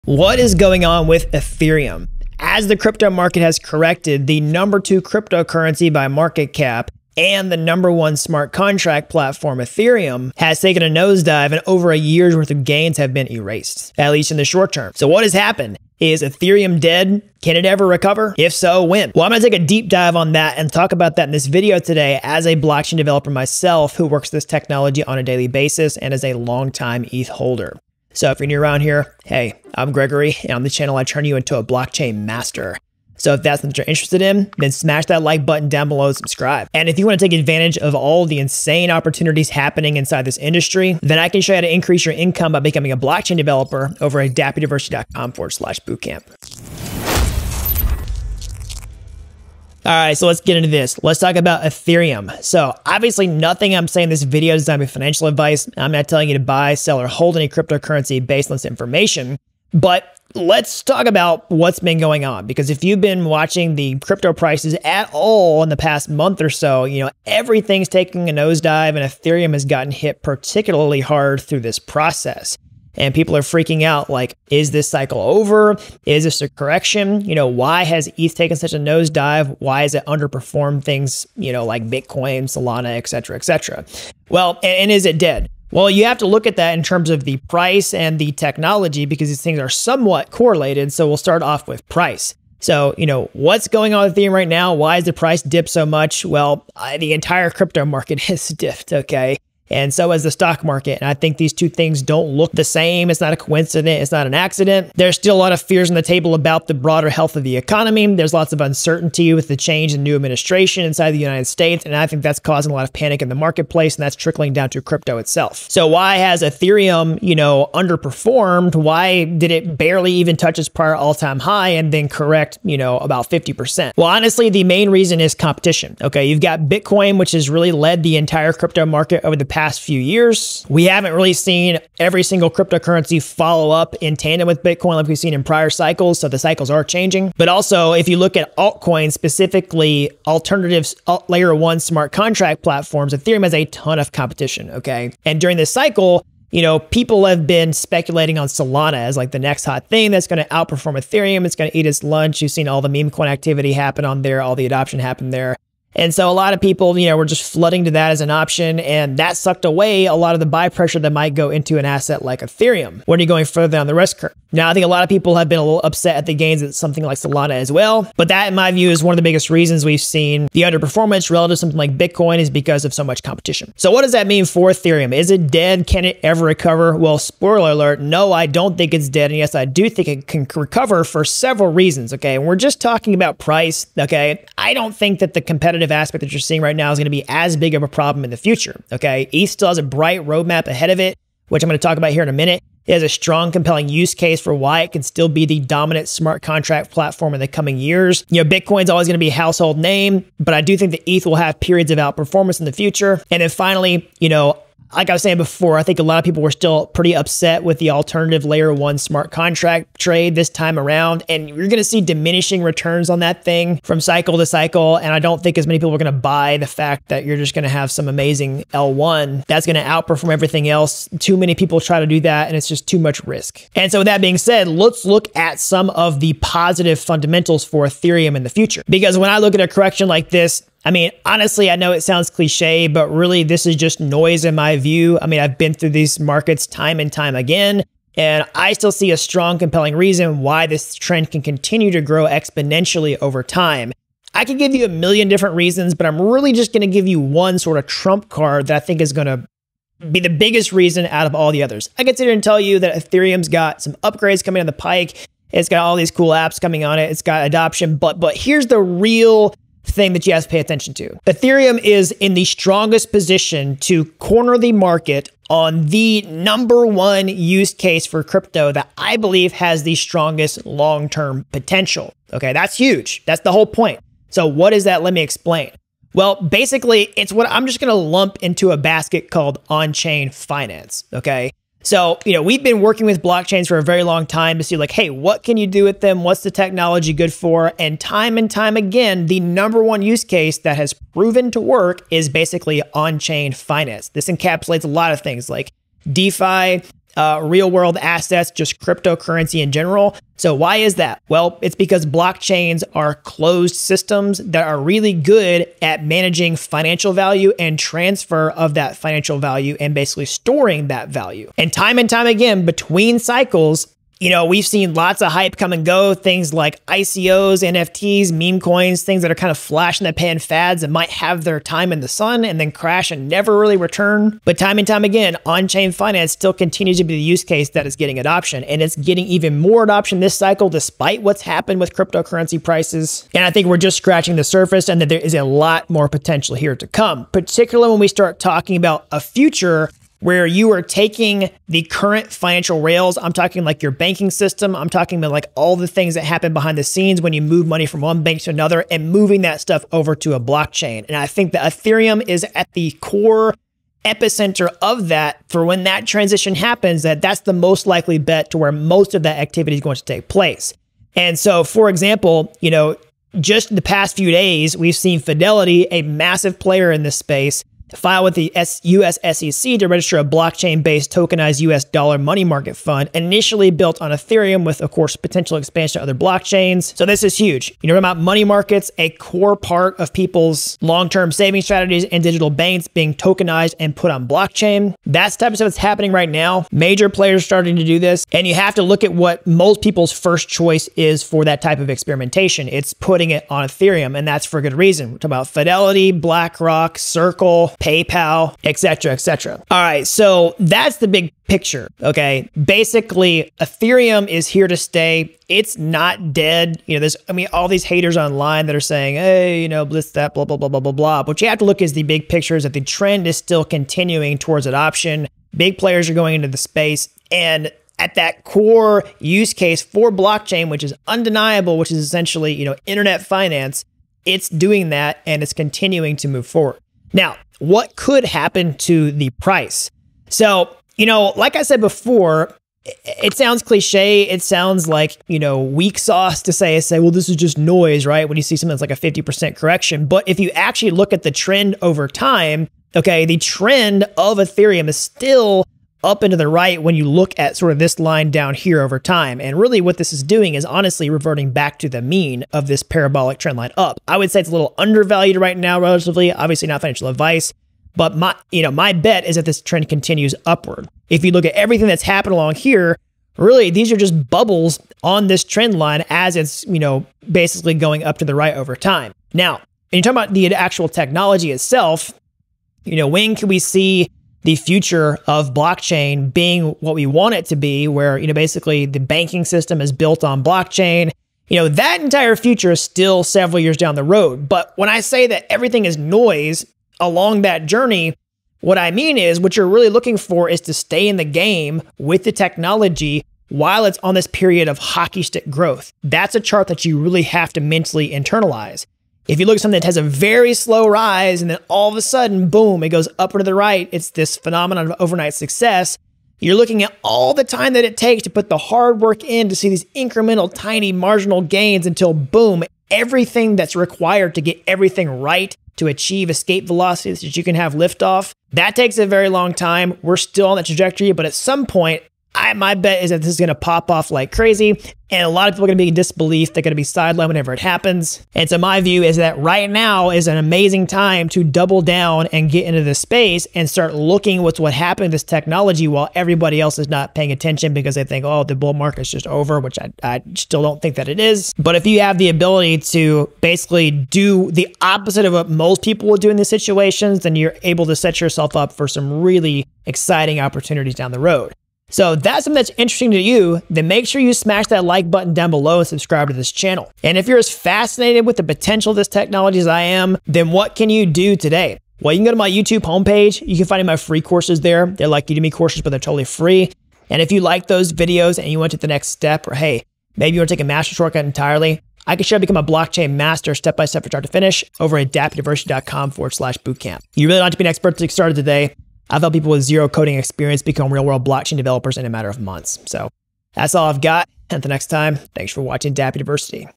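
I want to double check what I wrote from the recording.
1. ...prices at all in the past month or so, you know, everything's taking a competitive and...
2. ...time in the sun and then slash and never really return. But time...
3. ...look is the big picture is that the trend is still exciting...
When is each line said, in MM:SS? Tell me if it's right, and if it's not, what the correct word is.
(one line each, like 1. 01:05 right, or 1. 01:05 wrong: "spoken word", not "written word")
1. 01:04 wrong: "nosedive", not "competitive"
2. 05:21 wrong: "crash", not "slash"
3. 06:51 wrong: "continuing", not "exciting".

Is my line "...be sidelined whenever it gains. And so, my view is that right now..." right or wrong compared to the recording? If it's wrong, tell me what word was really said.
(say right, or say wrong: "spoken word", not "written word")
wrong: "happens", not "gains".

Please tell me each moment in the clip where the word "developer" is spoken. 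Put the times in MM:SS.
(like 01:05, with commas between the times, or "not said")
00:22, 00:43, 09:41.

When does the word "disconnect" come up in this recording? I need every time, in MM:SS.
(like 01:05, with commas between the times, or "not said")
not said.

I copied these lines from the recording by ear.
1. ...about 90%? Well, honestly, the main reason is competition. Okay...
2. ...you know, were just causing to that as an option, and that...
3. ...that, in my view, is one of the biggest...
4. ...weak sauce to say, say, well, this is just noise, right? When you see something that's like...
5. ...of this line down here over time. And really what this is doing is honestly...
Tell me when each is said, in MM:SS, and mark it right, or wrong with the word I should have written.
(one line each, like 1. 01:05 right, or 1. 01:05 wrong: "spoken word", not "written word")
1. 02:02 wrong: "50", not "90"
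2. 02:36 wrong: "flooding", not "causing"
3. 02:48 right
4. 07:15 right
5. 07:27 right.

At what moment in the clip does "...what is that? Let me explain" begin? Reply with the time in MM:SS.
04:34.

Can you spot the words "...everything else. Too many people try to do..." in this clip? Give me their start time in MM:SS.
03:40.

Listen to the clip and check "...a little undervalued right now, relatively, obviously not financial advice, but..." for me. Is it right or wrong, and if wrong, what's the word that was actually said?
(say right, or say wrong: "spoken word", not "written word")
right.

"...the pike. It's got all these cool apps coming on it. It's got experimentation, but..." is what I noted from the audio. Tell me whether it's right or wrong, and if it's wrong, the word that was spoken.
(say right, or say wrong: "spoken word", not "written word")
wrong: "adoption", not "experimentation".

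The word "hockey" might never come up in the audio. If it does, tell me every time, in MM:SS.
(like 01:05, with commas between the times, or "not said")
08:14.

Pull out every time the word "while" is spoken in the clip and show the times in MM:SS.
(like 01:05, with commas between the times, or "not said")
08:13, 08:55.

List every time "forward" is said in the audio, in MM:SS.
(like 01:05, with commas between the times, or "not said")
00:45, 07:06, 09:36.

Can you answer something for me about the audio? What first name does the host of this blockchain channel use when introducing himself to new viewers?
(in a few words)
Gregory.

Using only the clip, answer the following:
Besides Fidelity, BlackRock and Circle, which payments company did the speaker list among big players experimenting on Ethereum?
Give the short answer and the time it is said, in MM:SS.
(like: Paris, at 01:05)
PayPal, at 06:37.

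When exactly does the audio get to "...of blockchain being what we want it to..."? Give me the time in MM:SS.
07:55.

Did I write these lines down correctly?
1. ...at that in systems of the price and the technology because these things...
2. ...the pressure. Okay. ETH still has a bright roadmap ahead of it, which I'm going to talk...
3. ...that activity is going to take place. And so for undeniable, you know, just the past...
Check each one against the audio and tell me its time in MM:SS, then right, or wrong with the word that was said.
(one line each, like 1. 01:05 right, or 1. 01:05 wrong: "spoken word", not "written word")
1. 01:26 wrong: "terms", not "systems"
2. 03:08 wrong: "future", not "pressure"
3. 05:59 wrong: "example", not "undeniable".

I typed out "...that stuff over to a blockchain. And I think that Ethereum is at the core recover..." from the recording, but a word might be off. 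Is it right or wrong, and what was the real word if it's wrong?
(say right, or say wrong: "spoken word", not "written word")
wrong: "epicenter", not "recover".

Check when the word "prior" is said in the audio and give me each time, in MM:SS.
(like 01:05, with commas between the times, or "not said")
02:00, 02:15.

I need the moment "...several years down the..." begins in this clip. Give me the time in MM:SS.
08:03.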